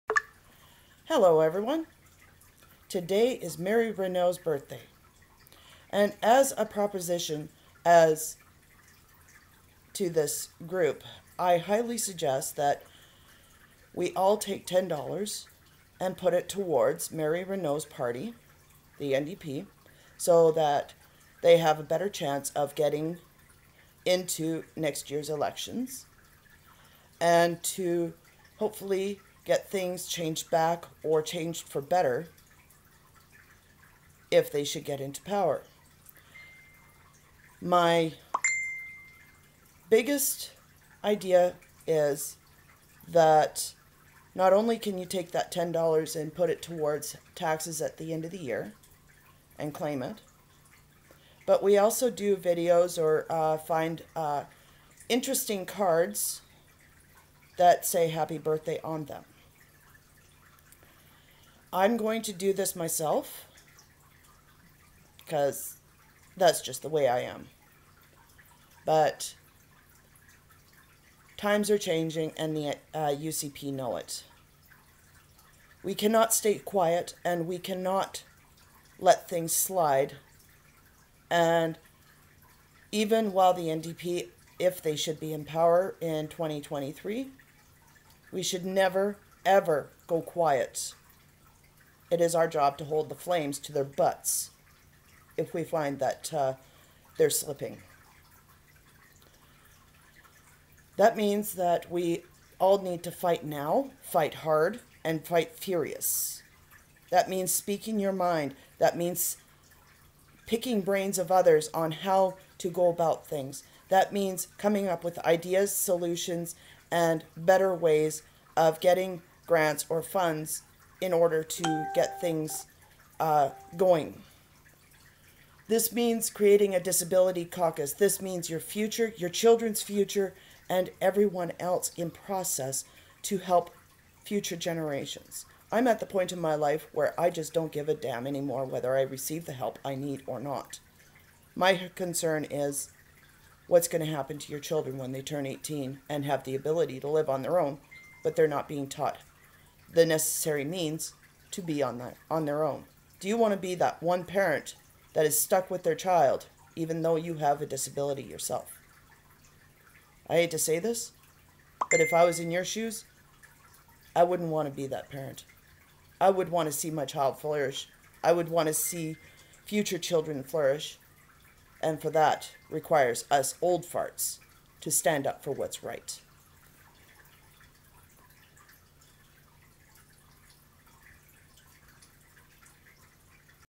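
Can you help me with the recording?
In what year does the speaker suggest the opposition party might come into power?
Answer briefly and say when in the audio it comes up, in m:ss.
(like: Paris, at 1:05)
2023, at 1:26.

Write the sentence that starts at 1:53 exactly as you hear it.
That means coming up with ideas, solutions, and better ways of getting grants or funds in order to get things uh, going.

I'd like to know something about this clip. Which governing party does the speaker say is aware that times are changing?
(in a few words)
UCP.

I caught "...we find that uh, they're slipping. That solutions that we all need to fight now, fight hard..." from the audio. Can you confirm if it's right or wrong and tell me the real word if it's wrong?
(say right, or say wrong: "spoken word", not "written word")
wrong: "means", not "solutions".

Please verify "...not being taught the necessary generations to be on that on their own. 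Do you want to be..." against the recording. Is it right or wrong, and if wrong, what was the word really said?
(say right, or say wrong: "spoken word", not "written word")
wrong: "means", not "generations".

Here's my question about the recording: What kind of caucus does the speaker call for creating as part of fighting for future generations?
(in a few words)
disability caucus.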